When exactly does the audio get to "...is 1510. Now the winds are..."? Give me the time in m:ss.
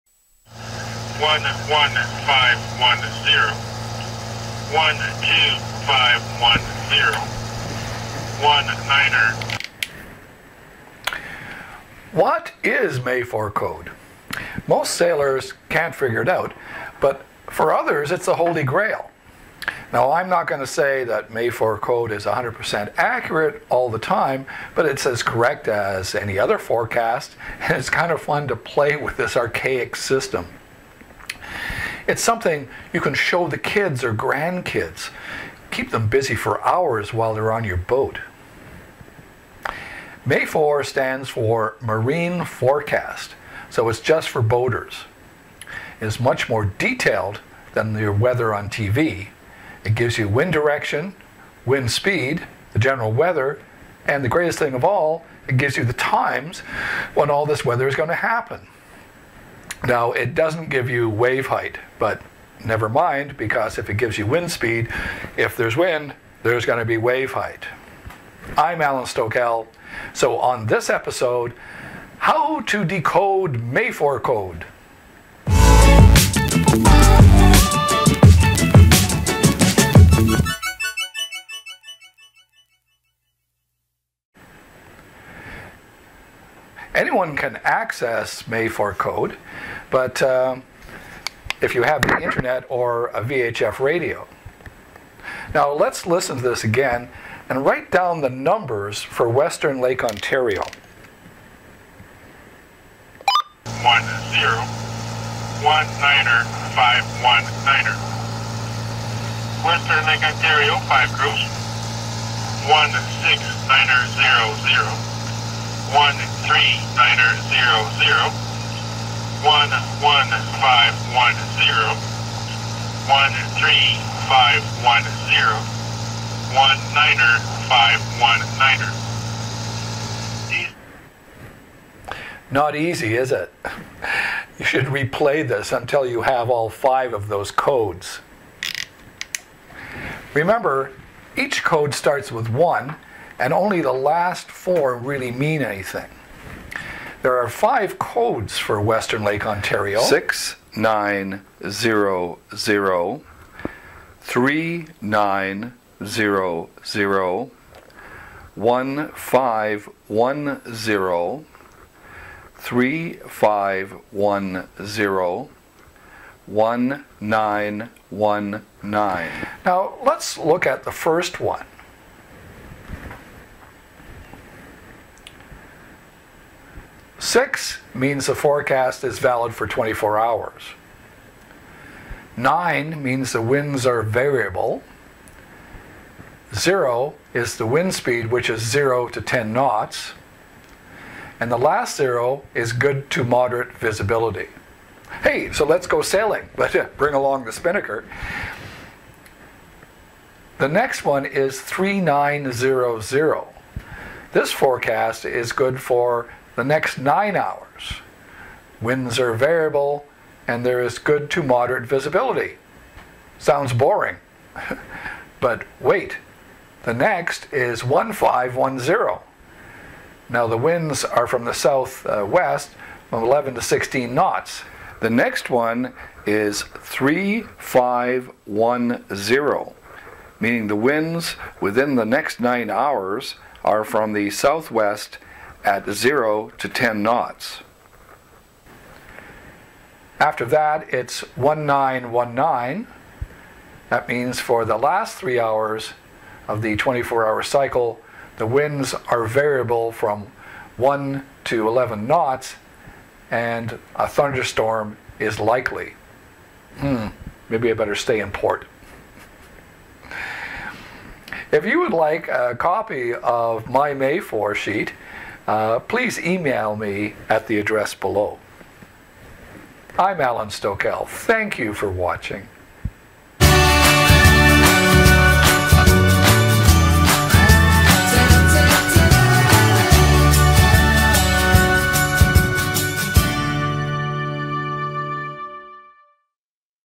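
3:37.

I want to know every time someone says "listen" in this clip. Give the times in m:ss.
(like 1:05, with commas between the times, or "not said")
1:36.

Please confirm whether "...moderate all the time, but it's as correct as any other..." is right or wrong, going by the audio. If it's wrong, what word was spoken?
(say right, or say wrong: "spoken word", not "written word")
wrong: "accurate", not "moderate".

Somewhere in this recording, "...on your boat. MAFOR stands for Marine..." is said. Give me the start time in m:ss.
0:37.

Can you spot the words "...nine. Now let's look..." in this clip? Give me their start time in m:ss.
2:48.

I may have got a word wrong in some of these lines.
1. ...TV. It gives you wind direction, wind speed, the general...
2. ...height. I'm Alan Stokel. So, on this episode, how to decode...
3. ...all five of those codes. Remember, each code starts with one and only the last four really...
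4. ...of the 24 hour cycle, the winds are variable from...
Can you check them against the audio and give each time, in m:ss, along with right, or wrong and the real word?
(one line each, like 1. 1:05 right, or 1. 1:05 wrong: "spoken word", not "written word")
1. 0:48 right
2. 1:07 right
3. 2:16 right
4. 4:06 right.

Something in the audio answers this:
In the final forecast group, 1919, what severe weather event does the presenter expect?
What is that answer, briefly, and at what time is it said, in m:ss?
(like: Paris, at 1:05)
A thunderstorm, at 4:14.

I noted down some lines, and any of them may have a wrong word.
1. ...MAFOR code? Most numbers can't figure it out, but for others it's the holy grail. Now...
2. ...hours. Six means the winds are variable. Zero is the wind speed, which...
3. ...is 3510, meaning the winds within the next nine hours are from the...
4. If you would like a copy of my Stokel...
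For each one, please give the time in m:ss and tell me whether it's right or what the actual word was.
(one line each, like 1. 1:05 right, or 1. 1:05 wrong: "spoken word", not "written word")
1. 0:12 wrong: "sailors", not "numbers"
2. 3:00 wrong: "Nine", not "Six"
3. 3:46 right
4. 4:21 wrong: "MAFOR", not "Stokel".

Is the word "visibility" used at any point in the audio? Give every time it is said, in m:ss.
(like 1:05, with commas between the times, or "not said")
3:13, 3:31.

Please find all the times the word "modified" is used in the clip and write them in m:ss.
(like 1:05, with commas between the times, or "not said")
not said.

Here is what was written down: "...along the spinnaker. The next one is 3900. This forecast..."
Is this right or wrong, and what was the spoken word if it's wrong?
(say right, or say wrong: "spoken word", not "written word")
right.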